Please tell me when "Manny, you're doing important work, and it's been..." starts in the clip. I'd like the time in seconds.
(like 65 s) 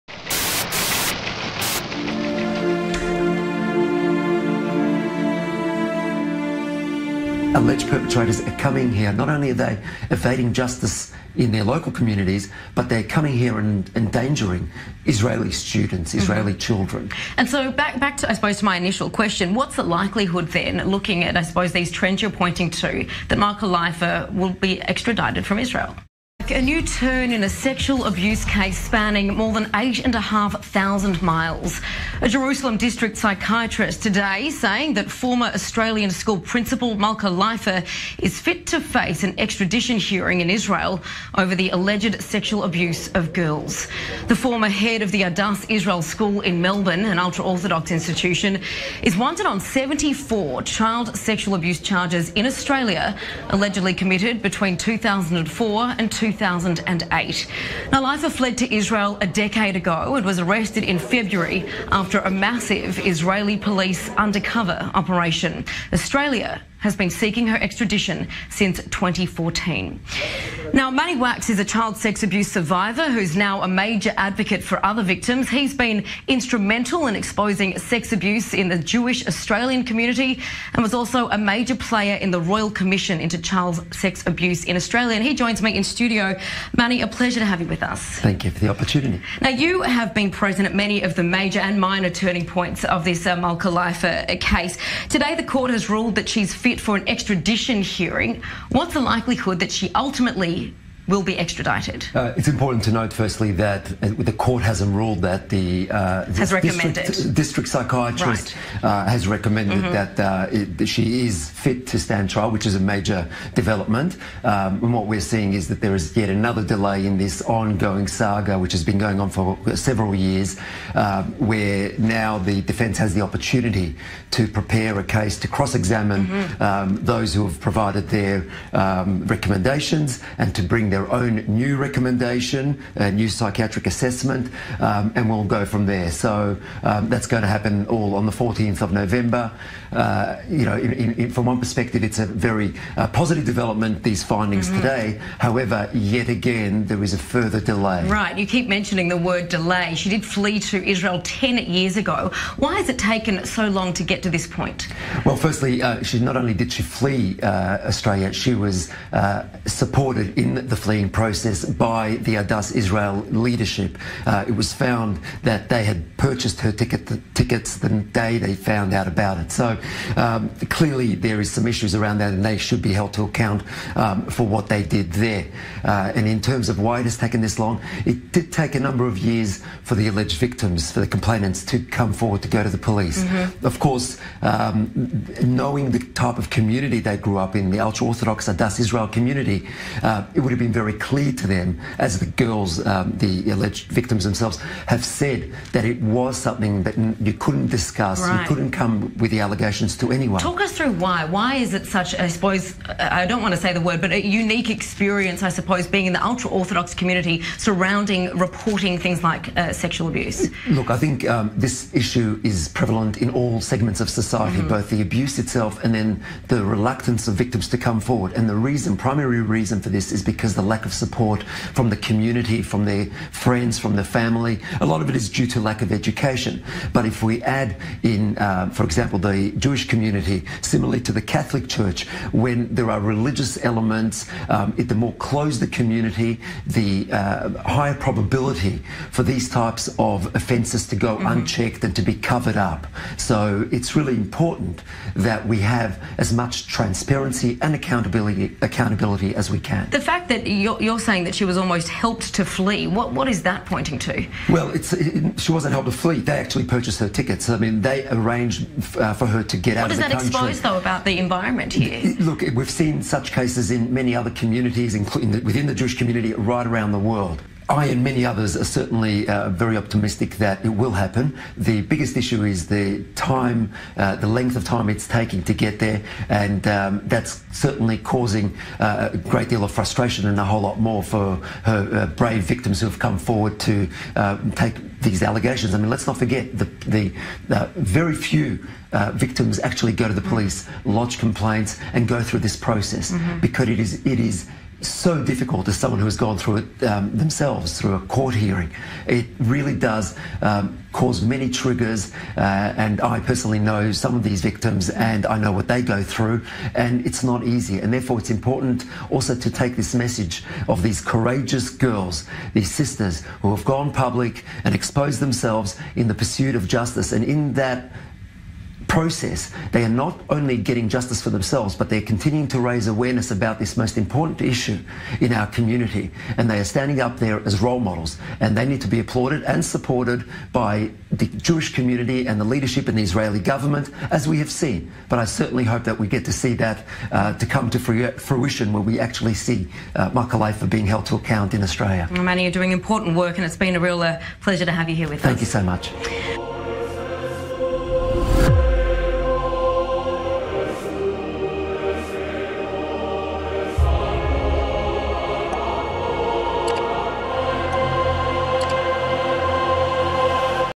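342 s.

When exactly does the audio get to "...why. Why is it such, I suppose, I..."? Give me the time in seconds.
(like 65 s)
200 s.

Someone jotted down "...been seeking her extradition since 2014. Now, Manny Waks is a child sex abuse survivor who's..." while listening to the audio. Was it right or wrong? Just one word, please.
right.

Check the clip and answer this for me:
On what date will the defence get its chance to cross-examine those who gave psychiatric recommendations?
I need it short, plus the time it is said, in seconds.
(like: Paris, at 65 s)
14 November, at 138 s.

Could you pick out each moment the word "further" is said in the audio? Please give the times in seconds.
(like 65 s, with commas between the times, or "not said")
147 s.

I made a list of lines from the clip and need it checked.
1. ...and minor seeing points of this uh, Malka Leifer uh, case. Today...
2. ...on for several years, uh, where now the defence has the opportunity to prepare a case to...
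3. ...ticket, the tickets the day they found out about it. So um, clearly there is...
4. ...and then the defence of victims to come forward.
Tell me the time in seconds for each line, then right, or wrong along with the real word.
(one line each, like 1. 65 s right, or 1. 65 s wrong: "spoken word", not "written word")
1. 91 s wrong: "turning", not "seeing"
2. 119 s right
3. 166 s right
4. 215 s wrong: "reluctance", not "defence".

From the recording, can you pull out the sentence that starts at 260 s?
What does that expose, though, about the environment here?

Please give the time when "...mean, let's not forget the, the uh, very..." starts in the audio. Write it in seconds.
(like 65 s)
285 s.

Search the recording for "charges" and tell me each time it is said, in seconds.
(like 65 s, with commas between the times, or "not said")
51 s.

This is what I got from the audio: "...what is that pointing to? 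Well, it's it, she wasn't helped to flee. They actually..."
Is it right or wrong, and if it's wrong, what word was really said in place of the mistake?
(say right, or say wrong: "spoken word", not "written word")
right.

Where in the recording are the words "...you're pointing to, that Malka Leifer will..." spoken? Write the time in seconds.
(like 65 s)
22 s.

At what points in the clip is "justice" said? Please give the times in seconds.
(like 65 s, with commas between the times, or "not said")
10 s, 316 s, 320 s.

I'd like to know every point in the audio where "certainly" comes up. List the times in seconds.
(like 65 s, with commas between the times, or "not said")
268 s, 277 s, 335 s.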